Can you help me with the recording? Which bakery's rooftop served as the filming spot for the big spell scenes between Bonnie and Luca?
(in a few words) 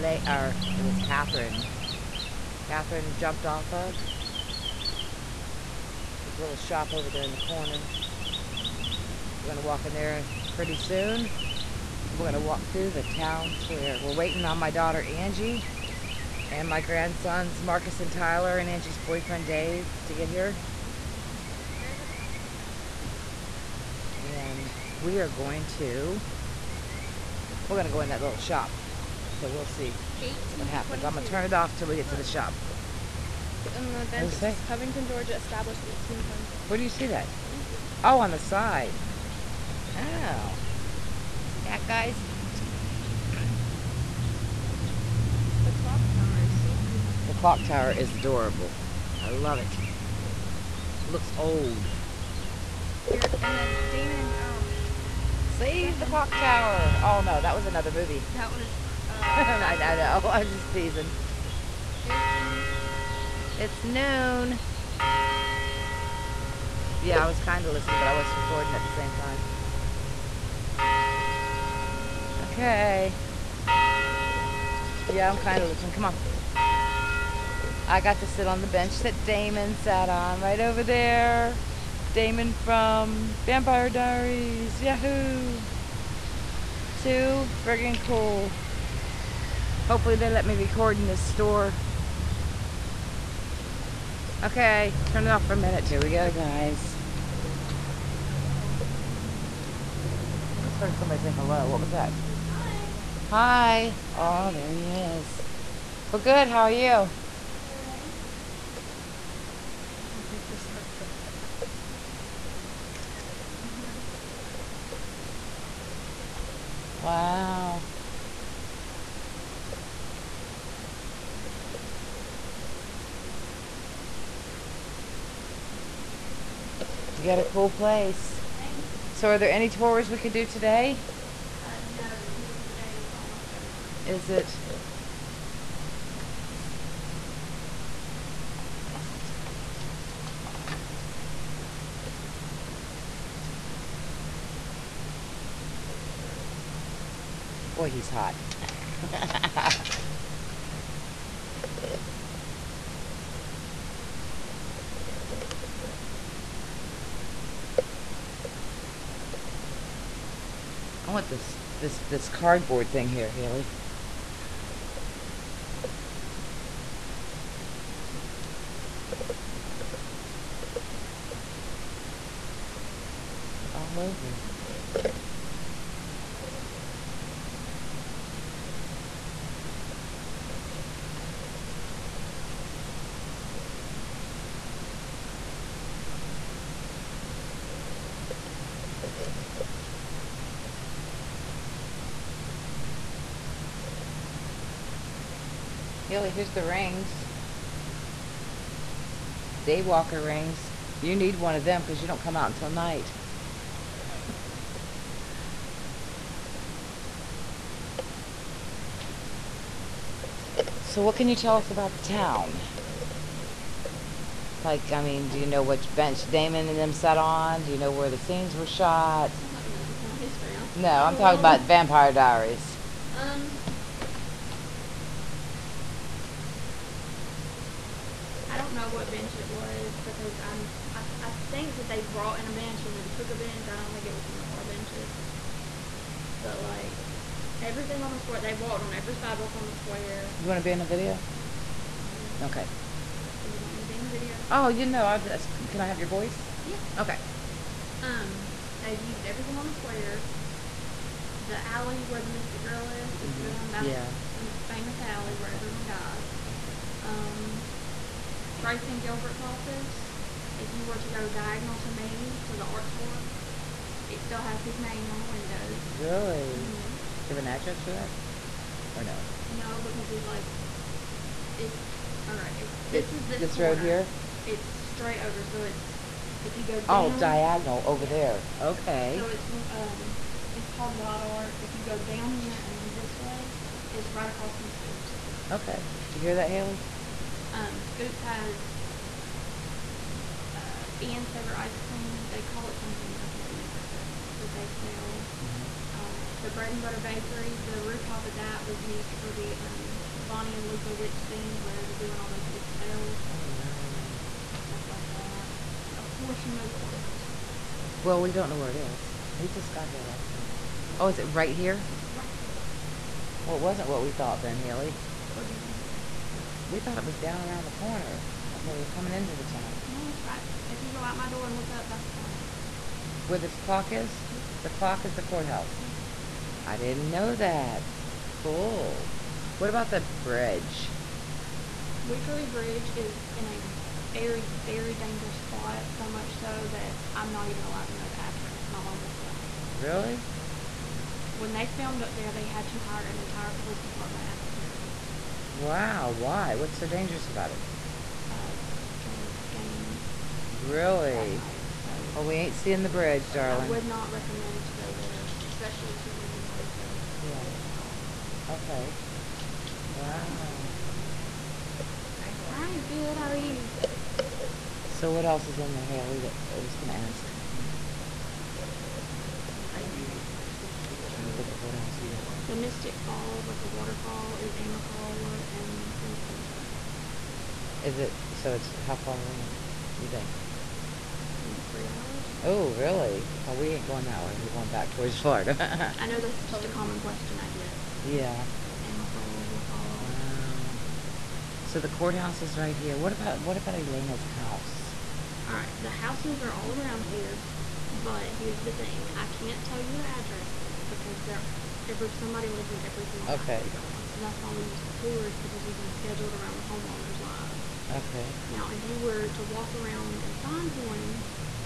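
Bread and butter bakery.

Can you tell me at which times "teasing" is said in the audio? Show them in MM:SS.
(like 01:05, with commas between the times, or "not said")
01:00.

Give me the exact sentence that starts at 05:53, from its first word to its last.
I would not recommend to go there, especially to women by yourself.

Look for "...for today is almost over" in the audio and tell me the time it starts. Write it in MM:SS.
02:12.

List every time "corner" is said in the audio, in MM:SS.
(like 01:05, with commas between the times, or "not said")
00:07, 04:33, 05:17.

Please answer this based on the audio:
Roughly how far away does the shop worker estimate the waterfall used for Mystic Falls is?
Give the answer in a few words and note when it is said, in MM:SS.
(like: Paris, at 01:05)
3 hours, at 06:21.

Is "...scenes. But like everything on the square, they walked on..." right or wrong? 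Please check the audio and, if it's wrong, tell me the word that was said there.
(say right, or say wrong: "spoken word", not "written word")
wrong: "benches", not "scenes".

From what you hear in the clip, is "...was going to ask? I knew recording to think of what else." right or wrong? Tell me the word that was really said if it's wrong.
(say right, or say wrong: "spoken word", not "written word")
wrong: "trying", not "recording".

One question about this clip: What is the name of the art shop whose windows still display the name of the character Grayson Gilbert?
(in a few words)
Wild Art.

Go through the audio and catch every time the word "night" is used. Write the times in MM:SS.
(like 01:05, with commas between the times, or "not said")
03:22, 05:10.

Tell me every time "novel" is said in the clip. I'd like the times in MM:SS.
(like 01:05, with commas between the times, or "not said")
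not said.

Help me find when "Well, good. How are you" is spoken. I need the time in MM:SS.
01:46.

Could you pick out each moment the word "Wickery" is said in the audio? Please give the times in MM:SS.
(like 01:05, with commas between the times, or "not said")
05:32.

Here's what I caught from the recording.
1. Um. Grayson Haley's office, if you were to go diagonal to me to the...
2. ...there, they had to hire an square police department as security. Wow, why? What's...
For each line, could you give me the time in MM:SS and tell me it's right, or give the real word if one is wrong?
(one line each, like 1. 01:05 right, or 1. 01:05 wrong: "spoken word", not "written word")
1. 04:17 wrong: "Gilbert", not "Haley"
2. 05:42 wrong: "entire", not "square".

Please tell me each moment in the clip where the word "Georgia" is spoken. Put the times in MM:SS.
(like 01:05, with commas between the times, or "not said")
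00:35, 06:16.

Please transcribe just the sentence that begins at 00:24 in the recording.
and we are going to, we're gonna go in that little shop.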